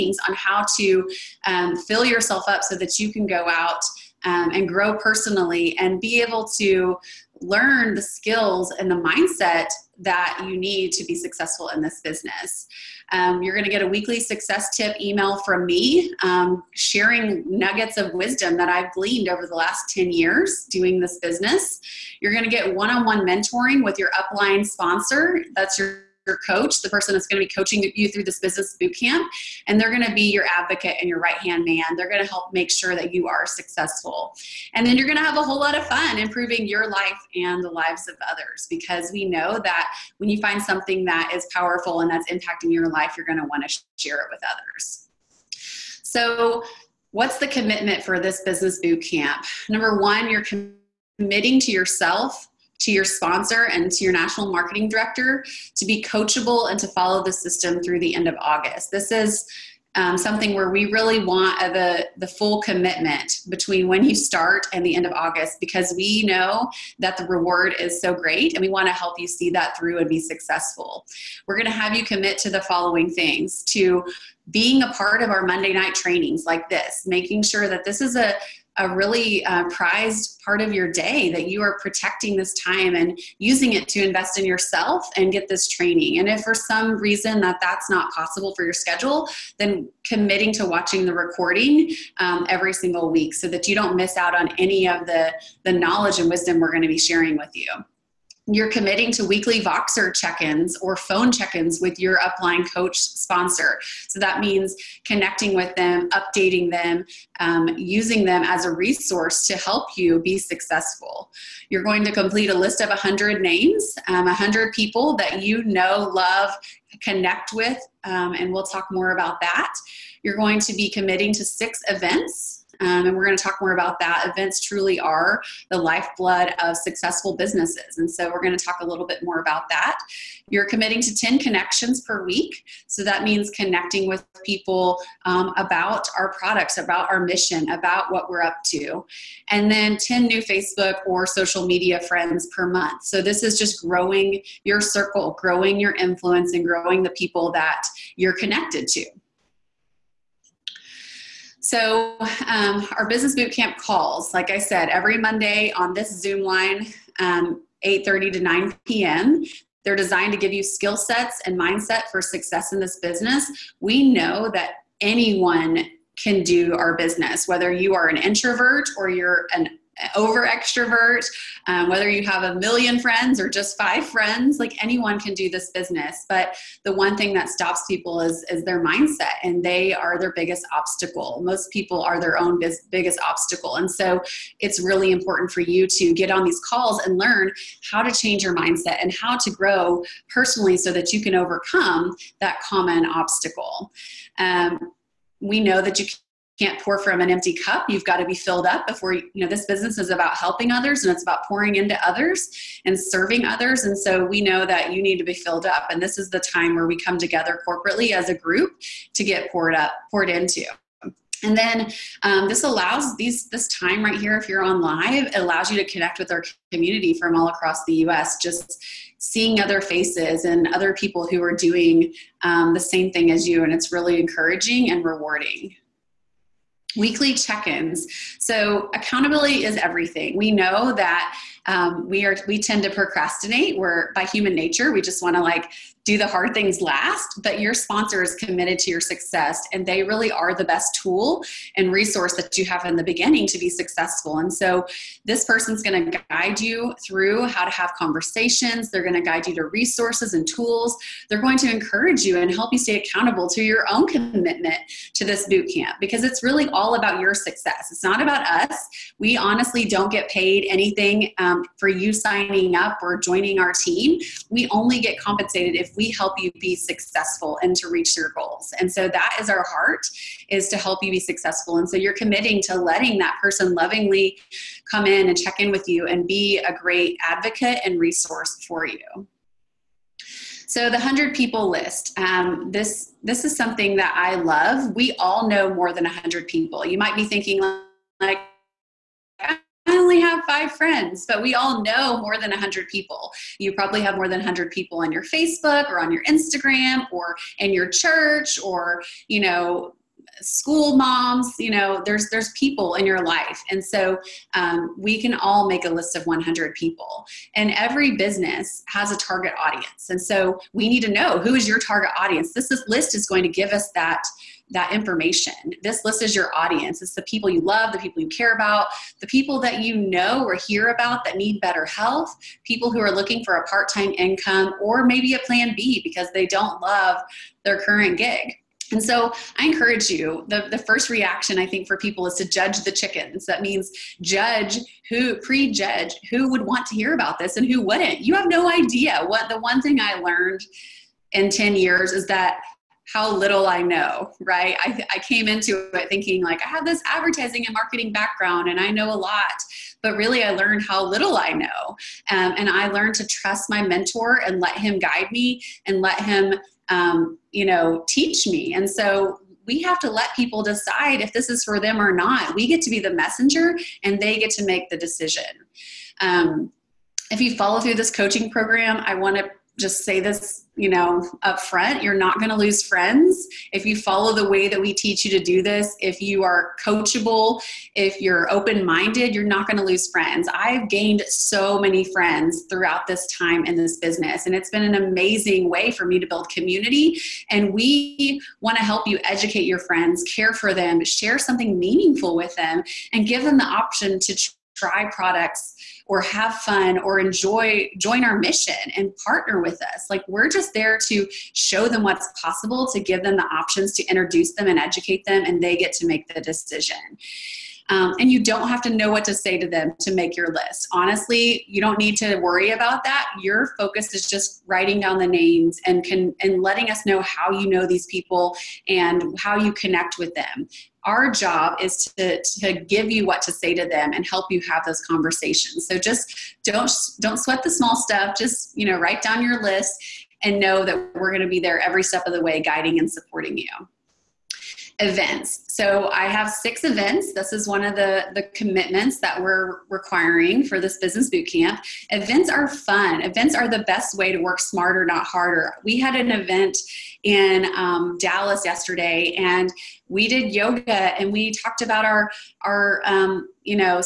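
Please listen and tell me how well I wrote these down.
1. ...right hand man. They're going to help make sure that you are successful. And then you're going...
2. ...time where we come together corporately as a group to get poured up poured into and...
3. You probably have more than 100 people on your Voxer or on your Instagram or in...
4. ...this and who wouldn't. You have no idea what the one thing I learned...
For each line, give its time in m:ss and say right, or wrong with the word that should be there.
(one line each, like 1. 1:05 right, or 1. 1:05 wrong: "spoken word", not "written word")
1. 0:31 right
2. 3:26 right
3. 4:53 wrong: "Facebook", not "Voxer"
4. 5:37 right.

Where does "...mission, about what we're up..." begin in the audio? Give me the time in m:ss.
2:17.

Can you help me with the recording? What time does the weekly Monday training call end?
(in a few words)
9 p.m.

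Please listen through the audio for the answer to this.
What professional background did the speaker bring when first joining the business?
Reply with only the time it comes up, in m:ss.
5:47.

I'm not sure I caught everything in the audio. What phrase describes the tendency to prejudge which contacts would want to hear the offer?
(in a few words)
judge the chickens.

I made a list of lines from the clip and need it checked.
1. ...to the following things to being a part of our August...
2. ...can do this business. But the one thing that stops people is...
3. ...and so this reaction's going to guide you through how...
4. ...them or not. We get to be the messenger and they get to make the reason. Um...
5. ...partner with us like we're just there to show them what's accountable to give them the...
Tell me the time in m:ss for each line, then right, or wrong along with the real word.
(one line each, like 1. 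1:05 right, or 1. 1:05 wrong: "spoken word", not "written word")
1. 1:12 wrong: "Monday", not "August"
2. 2:55 right
3. 4:04 wrong: "person", not "reaction"
4. 6:01 wrong: "decision", not "reason"
5. 6:39 wrong: "possible", not "accountable".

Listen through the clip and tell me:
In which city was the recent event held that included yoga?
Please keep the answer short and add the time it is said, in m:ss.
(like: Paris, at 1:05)
Dallas, at 7:28.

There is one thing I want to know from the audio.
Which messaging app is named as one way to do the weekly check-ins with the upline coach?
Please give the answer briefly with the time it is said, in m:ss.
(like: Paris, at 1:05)
Voxer, at 1:39.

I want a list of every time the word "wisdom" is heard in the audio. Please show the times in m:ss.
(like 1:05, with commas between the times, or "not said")
0:18, 1:36.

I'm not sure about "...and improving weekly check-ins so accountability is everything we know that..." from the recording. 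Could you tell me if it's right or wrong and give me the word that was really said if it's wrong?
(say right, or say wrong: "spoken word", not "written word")
wrong: "rewarding", not "improving".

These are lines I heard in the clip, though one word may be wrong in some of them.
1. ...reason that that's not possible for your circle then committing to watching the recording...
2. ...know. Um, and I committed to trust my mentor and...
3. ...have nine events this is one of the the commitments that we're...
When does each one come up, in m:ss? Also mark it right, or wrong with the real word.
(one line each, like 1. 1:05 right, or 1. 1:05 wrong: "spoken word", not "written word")
1. 1:26 wrong: "schedule", not "circle"
2. 5:51 wrong: "learned", not "committed"
3. 7:16 wrong: "six", not "nine".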